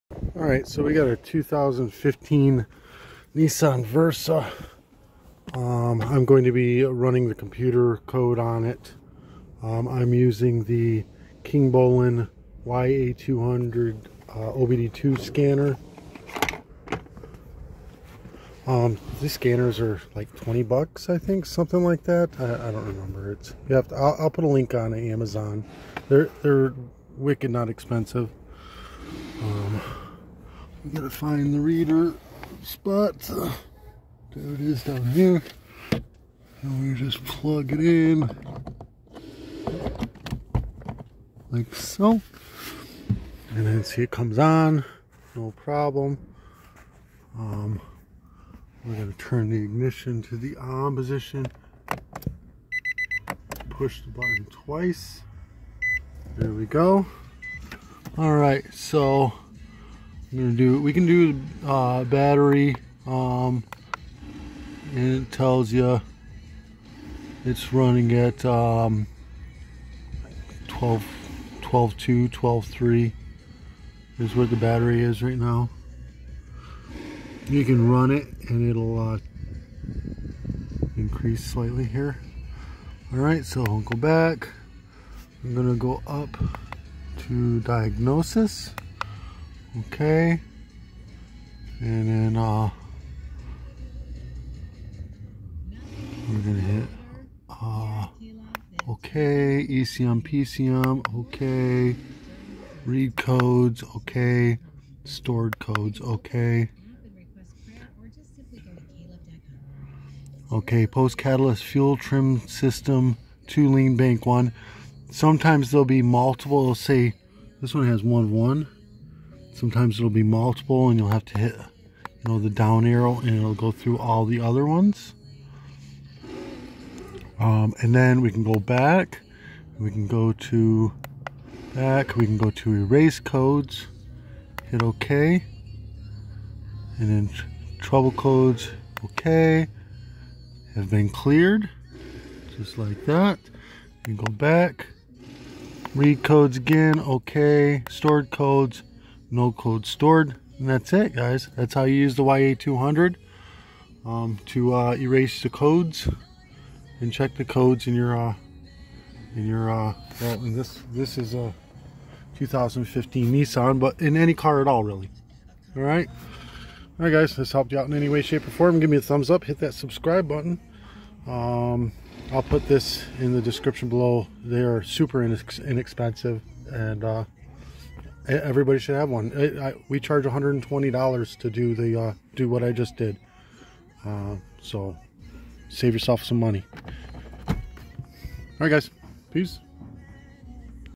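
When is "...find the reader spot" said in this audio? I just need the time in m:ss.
0:31.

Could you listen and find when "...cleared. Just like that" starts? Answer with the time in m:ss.
2:21.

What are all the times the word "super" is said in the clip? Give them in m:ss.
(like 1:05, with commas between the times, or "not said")
2:54.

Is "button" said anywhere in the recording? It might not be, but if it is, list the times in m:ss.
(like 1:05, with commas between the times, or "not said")
0:54, 2:50.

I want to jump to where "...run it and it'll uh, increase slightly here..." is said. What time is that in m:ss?
1:17.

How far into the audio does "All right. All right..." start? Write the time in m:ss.
2:45.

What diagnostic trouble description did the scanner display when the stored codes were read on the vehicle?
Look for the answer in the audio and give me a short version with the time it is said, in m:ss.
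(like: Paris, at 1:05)
Post catalyst fuel trim system too lean bank one, at 1:50.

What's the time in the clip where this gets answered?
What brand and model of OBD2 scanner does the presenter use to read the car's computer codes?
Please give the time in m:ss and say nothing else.
0:11.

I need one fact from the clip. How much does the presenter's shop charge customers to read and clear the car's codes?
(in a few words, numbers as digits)
$120.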